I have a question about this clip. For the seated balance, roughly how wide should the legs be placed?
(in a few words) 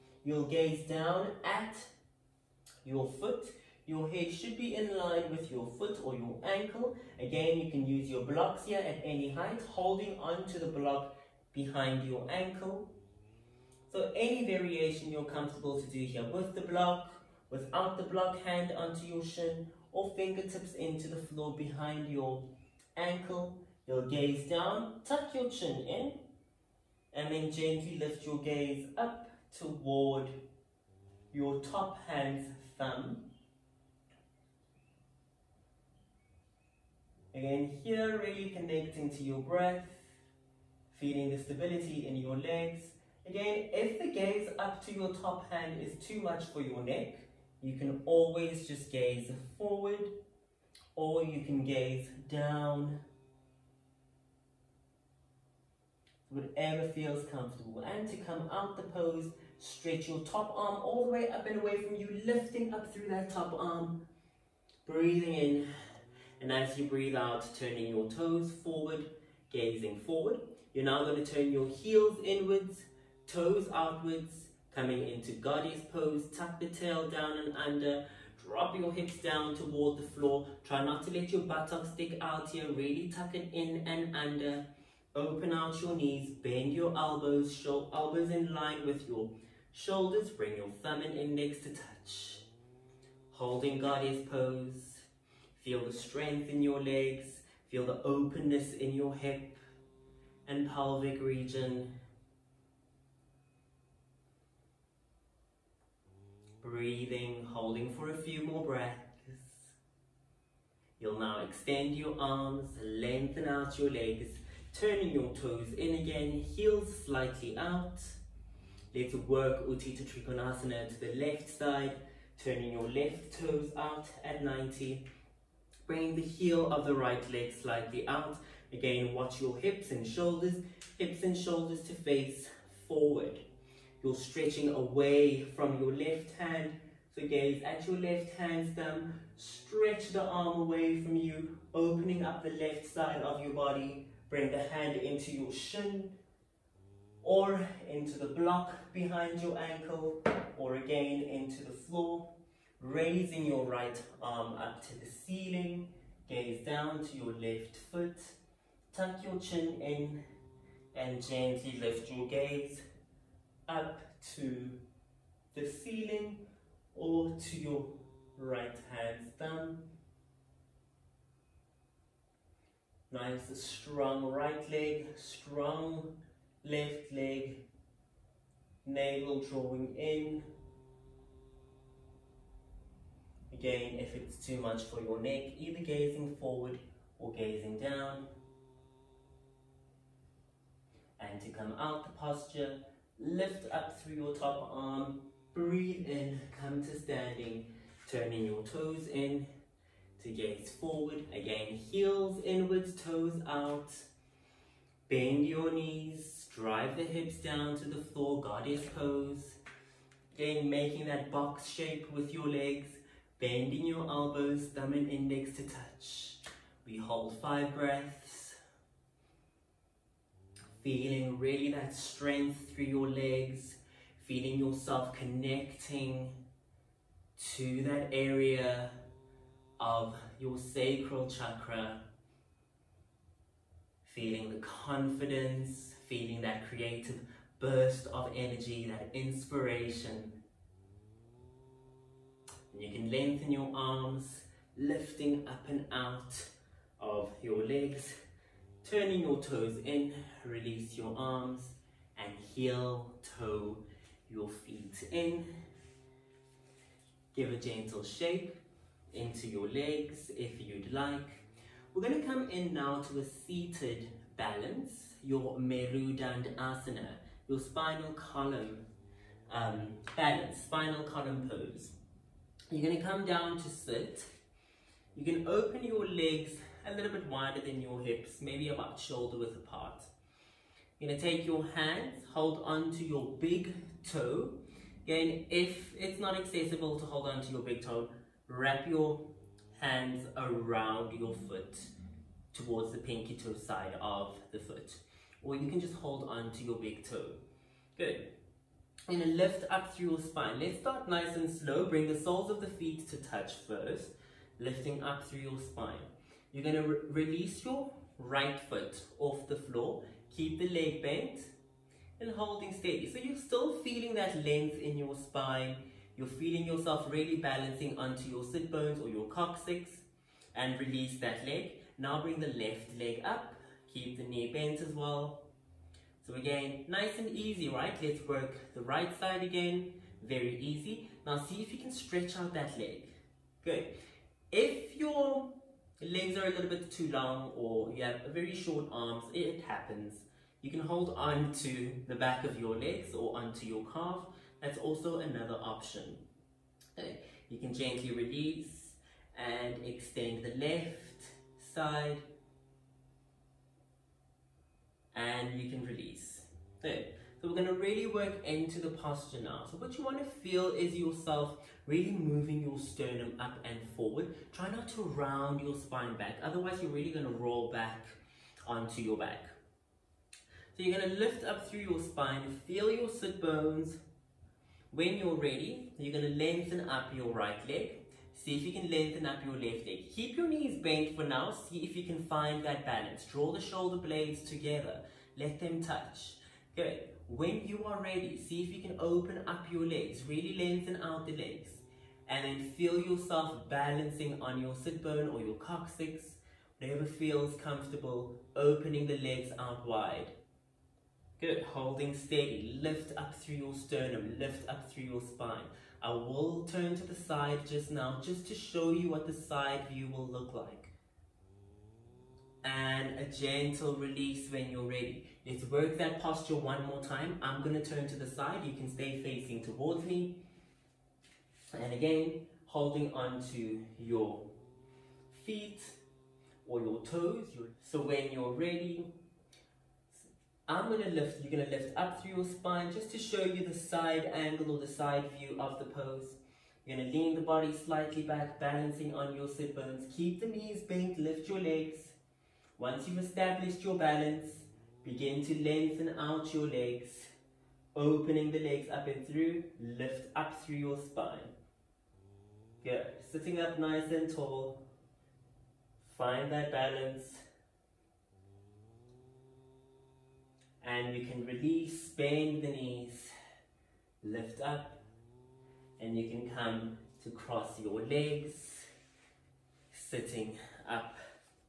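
Shoulder width apart.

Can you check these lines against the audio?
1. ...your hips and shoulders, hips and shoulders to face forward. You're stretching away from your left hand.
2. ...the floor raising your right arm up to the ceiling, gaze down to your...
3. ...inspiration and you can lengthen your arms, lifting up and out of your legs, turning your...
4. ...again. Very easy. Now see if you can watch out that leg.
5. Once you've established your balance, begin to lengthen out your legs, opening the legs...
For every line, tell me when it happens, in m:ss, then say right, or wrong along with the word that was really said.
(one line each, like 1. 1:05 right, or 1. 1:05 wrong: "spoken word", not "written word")
1. 2:09 right
2. 2:31 right
3. 3:59 right
4. 5:29 wrong: "stretch", not "watch"
5. 7:22 right.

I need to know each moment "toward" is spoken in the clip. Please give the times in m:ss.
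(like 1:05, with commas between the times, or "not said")
0:29, 1:19, 4:52, 6:59.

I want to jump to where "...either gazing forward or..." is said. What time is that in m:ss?
3:05.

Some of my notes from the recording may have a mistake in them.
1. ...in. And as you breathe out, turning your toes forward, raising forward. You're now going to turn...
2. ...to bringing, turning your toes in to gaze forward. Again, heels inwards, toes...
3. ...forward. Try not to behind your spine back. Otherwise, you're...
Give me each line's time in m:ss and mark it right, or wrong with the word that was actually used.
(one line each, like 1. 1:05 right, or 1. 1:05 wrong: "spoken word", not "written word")
1. 1:05 wrong: "gazing", not "raising"
2. 3:16 wrong: "standing", not "bringing"
3. 6:03 wrong: "round", not "behind".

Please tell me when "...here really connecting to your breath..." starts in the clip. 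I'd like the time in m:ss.
0:37.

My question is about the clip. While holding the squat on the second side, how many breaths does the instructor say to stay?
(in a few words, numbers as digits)
Five breaths.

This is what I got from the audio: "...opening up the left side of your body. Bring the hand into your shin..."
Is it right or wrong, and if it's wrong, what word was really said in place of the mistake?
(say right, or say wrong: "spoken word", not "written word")
right.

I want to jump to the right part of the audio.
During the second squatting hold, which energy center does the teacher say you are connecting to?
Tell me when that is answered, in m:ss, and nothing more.
3:50.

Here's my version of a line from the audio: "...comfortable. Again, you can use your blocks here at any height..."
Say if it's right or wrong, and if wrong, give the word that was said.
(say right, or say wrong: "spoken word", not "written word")
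wrong: "ankle", not "comfortable".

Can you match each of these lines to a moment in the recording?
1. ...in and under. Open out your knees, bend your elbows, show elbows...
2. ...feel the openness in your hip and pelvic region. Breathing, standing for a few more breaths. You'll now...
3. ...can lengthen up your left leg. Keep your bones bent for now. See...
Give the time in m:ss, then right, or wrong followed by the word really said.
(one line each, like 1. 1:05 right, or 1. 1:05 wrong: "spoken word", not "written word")
1. 1:23 right
2. 1:37 wrong: "holding", not "standing"
3. 6:18 wrong: "knees", not "bones".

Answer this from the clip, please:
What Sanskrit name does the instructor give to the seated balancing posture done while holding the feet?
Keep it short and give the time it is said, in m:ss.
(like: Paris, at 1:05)
Merudandasana, at 4:25.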